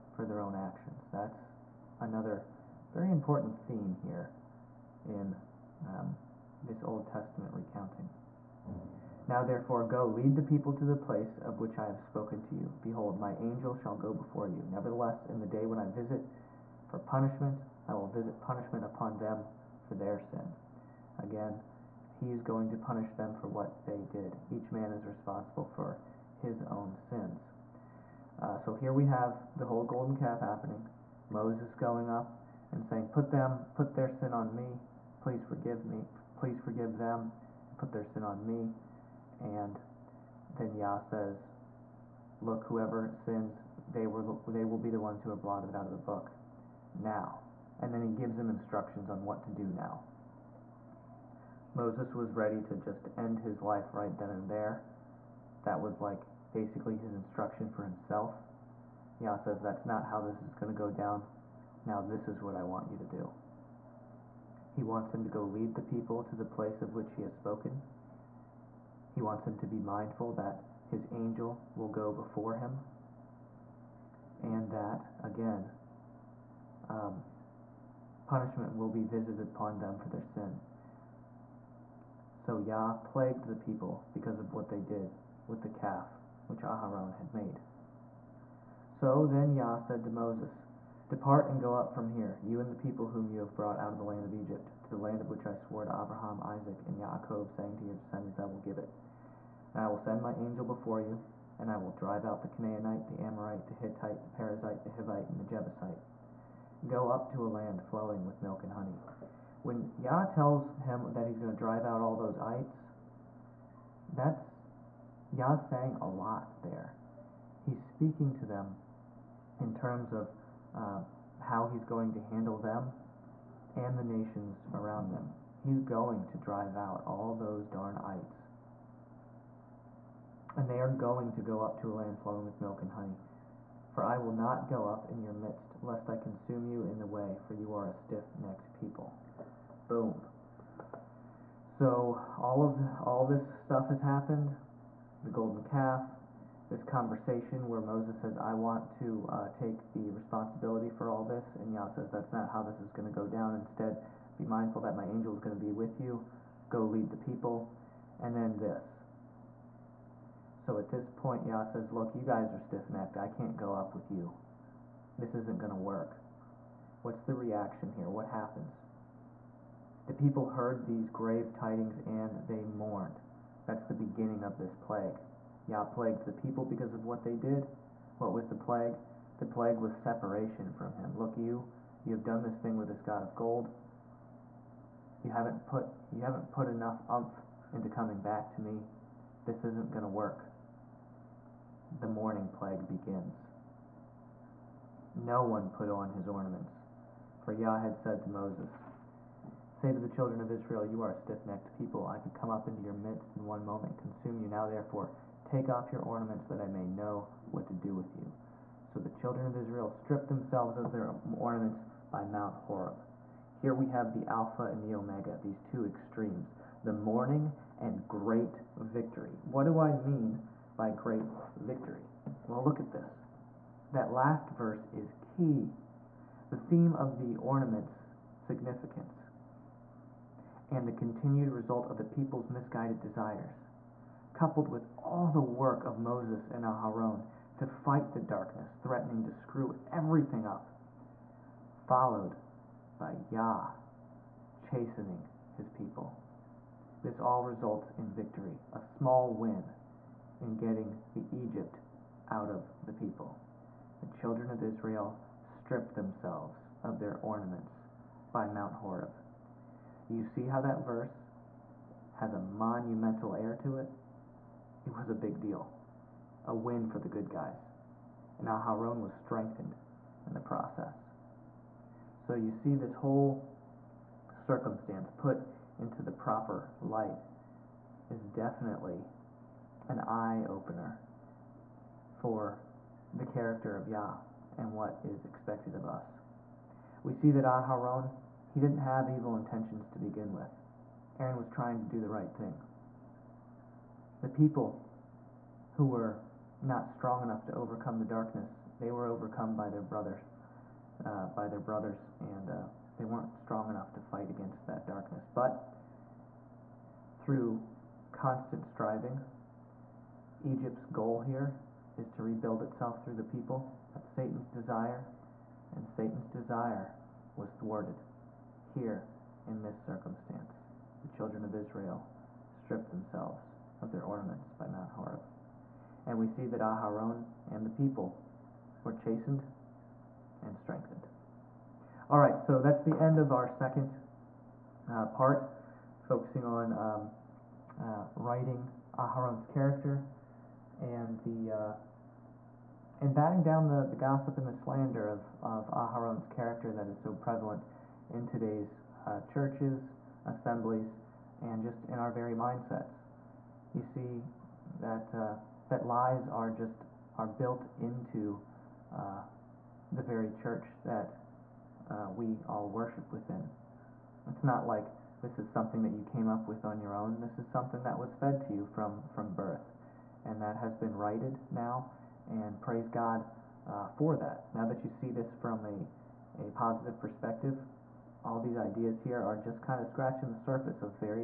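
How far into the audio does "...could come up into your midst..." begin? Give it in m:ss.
3:22.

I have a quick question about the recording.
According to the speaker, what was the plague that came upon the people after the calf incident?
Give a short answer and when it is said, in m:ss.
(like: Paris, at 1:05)
Separation from him, at 2:59.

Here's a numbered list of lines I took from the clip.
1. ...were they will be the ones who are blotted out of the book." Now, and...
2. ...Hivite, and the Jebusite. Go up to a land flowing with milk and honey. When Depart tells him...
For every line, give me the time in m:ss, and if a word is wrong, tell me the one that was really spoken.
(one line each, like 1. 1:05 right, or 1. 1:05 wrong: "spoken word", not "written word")
1. 0:44 right
2. 1:44 wrong: "Yah", not "Depart".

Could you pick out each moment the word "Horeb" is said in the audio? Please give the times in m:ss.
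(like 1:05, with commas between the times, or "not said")
3:32, 4:18, 5:24.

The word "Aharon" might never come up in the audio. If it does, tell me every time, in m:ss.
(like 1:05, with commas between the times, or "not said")
1:26, 3:56, 4:28, 4:47, 5:26, 5:38, 5:45.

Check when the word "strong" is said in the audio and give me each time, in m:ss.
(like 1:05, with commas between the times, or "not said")
4:56, 5:03.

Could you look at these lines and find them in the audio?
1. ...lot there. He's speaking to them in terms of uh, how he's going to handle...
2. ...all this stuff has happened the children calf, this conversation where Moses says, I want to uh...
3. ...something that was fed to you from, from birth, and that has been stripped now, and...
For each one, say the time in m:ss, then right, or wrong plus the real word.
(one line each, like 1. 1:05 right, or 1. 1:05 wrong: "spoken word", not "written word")
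1. 1:56 right
2. 2:23 wrong: "golden", not "children"
3. 6:07 wrong: "righted", not "stripped".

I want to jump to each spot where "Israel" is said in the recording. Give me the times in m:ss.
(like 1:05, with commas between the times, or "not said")
3:20, 3:29, 4:14, 5:21.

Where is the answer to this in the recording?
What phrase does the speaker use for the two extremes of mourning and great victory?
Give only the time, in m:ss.
3:34.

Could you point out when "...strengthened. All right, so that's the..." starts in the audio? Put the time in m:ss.
5:30.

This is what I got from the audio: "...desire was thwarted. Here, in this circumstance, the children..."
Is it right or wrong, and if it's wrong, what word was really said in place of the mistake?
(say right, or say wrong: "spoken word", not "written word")
right.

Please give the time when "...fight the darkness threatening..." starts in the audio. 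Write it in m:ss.
3:57.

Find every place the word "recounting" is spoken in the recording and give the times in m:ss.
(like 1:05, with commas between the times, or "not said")
0:07.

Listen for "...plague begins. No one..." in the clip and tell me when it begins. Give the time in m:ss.
3:12.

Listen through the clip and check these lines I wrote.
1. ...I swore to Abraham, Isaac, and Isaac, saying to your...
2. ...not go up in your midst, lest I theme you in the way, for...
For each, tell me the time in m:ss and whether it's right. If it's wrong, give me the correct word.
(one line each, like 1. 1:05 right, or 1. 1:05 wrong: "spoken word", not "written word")
1. 1:35 wrong: "Jacob", not "Isaac"
2. 2:14 wrong: "consume", not "theme".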